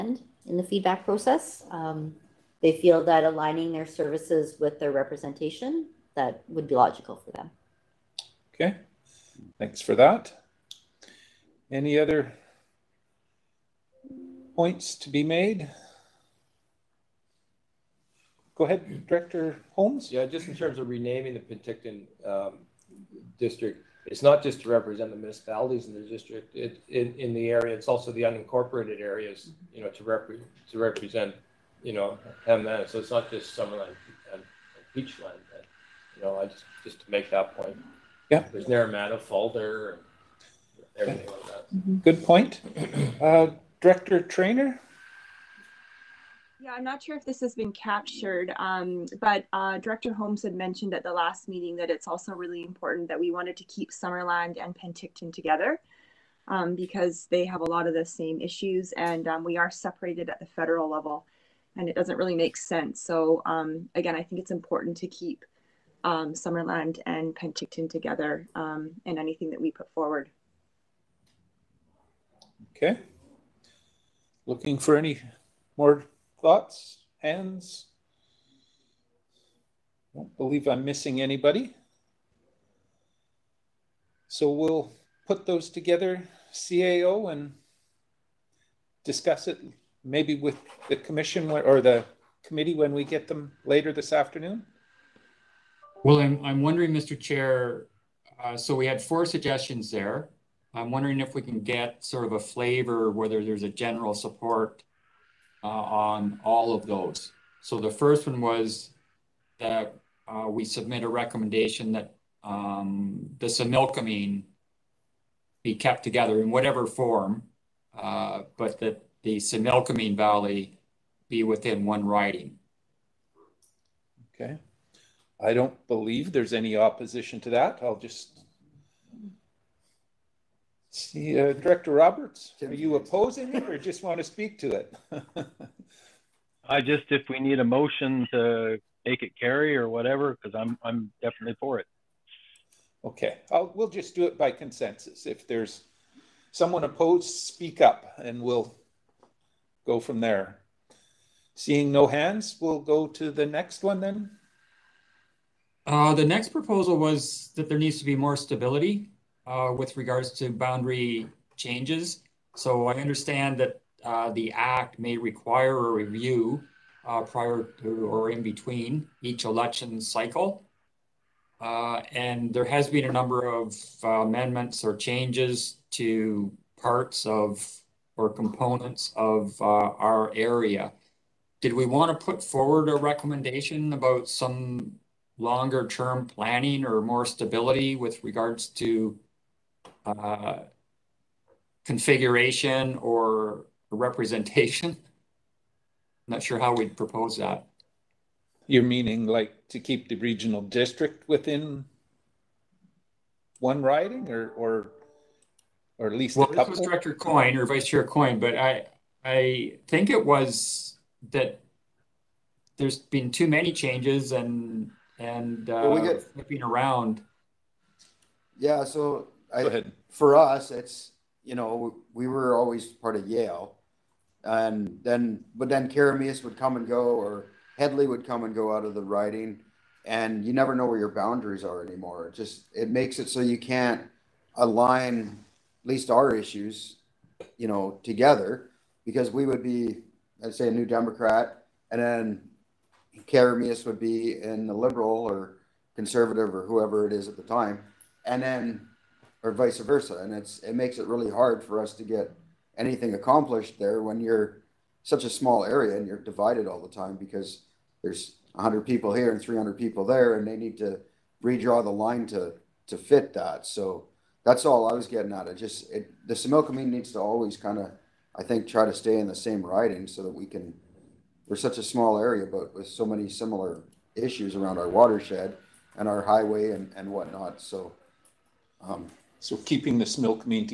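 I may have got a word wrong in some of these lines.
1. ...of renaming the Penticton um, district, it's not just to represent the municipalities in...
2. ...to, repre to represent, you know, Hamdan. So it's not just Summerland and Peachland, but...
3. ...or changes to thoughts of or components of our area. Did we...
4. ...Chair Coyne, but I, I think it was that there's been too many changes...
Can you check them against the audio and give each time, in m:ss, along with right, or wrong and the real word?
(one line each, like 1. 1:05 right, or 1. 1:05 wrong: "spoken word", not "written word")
1. 0:20 right
2. 0:29 right
3. 2:54 wrong: "parts", not "thoughts"
4. 3:27 right.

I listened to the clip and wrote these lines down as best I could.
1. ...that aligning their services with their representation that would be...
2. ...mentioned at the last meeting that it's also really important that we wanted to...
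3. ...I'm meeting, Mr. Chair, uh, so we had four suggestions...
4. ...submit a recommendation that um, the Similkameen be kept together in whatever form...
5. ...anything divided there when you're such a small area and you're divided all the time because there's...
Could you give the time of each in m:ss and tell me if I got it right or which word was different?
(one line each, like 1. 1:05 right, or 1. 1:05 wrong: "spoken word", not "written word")
1. 0:03 right
2. 0:50 right
3. 1:36 wrong: "wondering", not "meeting"
4. 1:50 right
5. 4:12 wrong: "accomplished", not "divided".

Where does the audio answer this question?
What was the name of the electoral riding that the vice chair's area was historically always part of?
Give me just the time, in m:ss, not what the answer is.
3:43.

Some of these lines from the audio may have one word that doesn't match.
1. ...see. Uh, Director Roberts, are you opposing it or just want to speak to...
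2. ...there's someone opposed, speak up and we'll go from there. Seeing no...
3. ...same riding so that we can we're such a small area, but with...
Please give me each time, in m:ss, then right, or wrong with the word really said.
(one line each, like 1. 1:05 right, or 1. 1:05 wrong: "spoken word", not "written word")
1. 2:10 right
2. 2:25 right
3. 4:29 right.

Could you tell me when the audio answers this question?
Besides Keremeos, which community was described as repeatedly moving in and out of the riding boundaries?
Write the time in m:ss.
3:47.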